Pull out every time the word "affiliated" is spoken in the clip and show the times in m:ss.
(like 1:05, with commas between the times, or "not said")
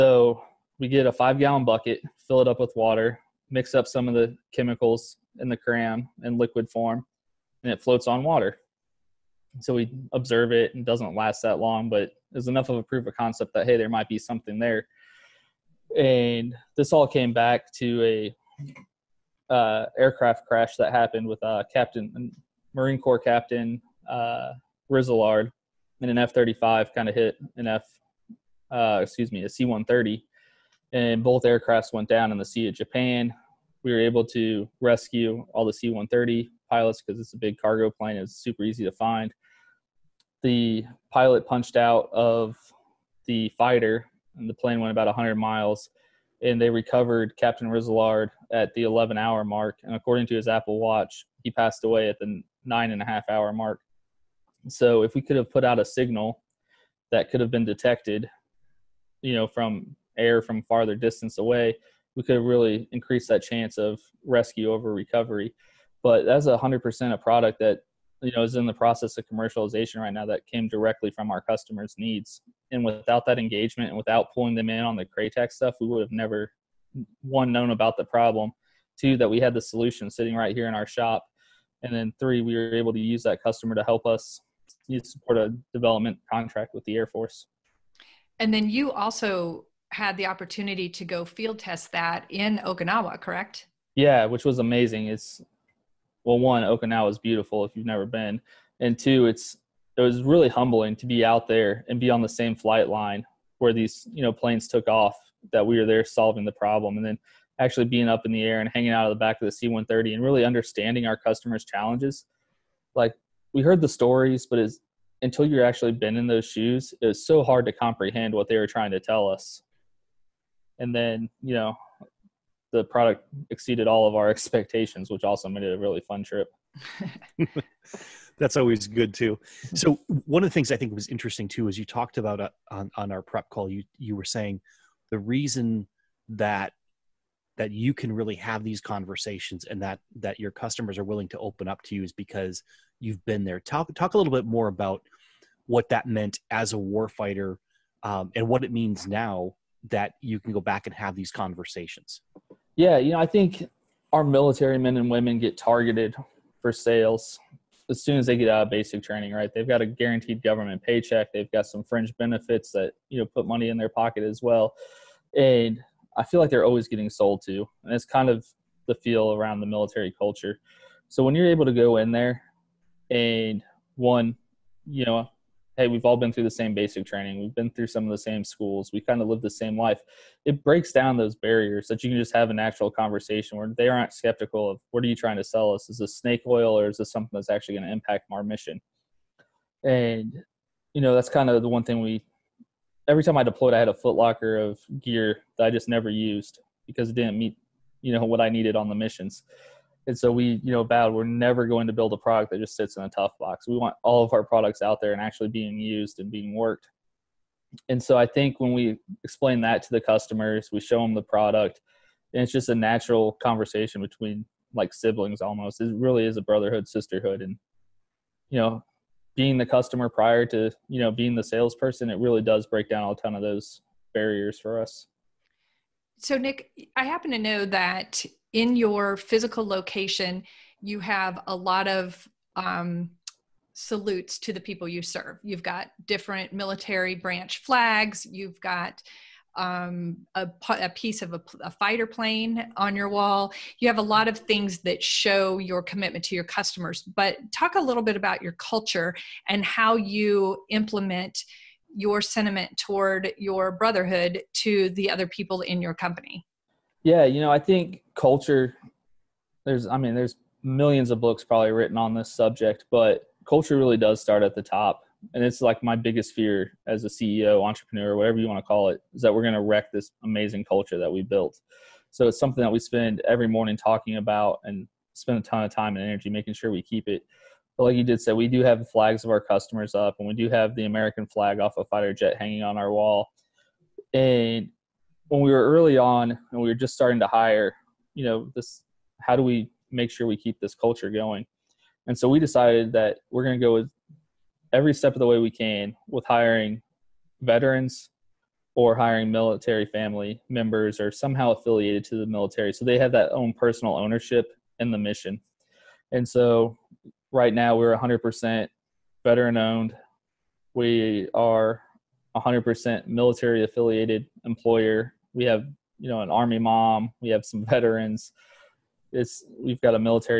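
5:01, 5:13.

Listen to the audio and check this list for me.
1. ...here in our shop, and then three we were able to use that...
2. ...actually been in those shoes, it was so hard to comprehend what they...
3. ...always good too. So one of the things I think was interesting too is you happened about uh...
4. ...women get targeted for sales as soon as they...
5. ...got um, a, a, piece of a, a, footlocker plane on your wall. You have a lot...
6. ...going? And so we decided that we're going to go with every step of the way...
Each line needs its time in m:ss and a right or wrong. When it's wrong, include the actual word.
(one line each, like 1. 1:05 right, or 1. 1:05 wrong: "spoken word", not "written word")
1. 1:20 right
2. 1:55 right
3. 2:08 wrong: "talked", not "happened"
4. 2:35 right
5. 3:58 wrong: "fighter", not "footlocker"
6. 4:51 right.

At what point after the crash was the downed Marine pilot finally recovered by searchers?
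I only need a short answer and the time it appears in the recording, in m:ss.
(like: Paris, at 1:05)
11 hour mark, at 0:48.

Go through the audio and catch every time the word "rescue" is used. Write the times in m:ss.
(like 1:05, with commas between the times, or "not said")
0:34, 1:04.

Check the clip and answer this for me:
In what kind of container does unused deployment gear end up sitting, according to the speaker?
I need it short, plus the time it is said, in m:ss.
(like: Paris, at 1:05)
tough box, at 3:23.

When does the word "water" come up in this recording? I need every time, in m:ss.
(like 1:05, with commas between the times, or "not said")
0:02, 0:08.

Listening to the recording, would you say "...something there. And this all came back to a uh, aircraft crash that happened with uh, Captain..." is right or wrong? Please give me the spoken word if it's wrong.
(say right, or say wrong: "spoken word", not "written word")
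right.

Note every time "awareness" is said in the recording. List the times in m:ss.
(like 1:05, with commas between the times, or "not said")
not said.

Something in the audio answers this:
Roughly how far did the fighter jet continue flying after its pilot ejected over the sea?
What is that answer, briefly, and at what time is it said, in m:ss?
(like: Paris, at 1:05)
100 miles, at 0:45.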